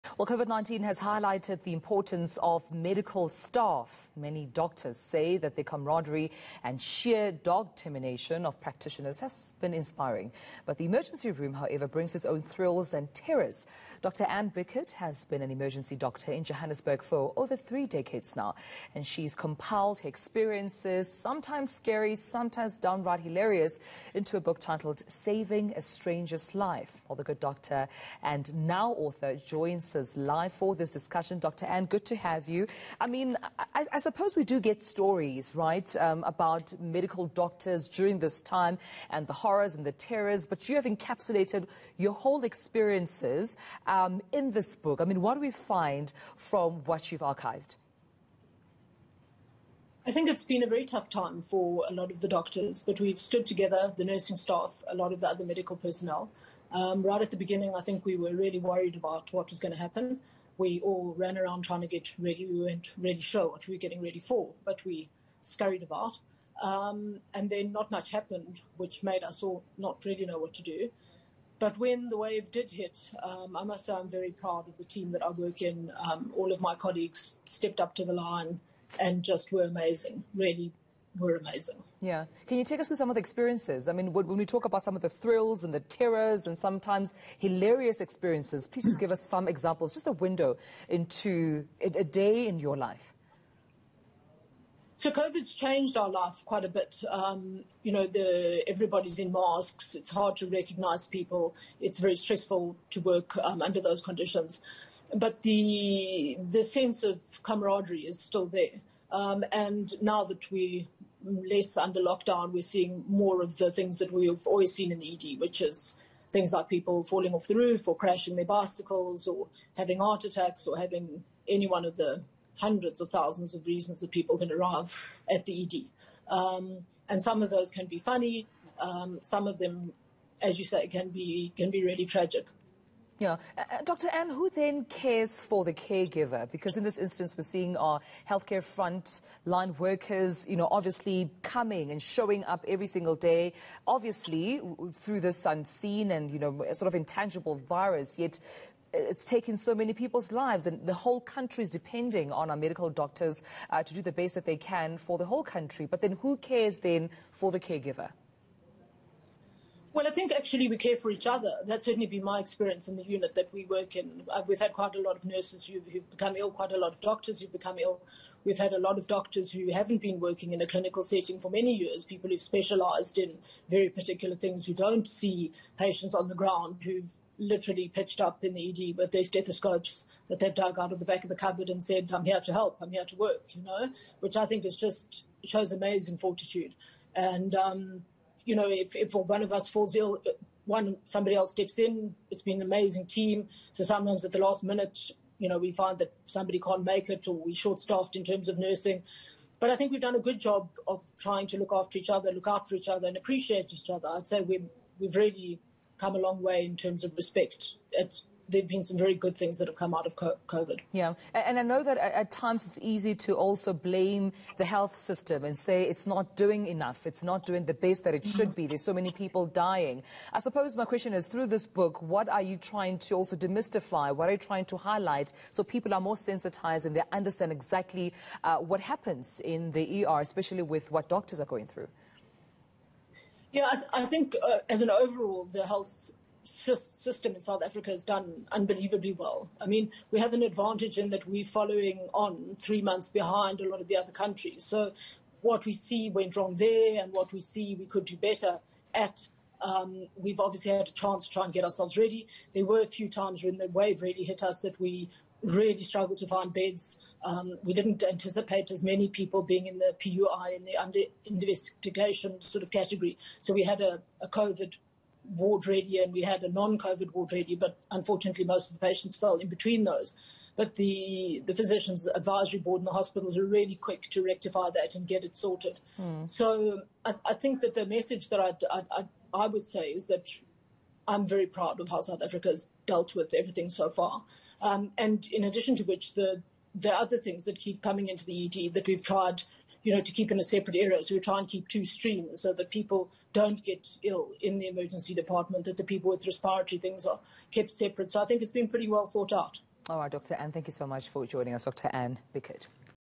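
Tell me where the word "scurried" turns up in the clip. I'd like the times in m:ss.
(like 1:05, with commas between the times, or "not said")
1:05.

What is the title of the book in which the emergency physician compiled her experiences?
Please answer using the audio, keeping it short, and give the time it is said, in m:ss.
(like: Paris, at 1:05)
Saving a Stranger's Life, at 0:25.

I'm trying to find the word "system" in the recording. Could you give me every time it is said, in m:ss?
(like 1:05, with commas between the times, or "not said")
3:34, 3:56.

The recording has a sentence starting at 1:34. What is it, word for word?
So COVID's changed our life quite a bit.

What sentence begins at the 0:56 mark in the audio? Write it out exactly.
Um, right at the beginning, I think we were really worried about what was going to happen.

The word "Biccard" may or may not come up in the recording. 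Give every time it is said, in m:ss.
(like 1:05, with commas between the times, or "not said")
0:14, 5:02.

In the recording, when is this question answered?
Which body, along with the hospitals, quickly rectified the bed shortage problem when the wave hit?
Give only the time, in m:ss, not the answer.
4:31.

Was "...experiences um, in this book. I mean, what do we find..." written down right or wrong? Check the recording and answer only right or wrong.
right.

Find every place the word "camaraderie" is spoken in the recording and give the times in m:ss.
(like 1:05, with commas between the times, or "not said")
0:05, 1:47.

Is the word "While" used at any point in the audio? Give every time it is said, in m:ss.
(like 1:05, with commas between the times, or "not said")
0:27.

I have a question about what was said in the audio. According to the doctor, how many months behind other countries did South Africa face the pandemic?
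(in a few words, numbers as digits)
3.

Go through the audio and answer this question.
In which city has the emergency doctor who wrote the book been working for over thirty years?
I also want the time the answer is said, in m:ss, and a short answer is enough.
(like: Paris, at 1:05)
Johannesburg, at 0:16.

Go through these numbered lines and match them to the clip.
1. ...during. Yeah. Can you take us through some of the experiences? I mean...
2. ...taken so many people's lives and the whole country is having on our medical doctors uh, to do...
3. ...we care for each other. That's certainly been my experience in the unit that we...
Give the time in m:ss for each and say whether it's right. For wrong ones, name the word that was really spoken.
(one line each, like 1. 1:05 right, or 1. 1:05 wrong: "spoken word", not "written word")
1. 1:21 wrong: "amazing", not "during"
2. 2:29 wrong: "depending", not "having"
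3. 2:40 right.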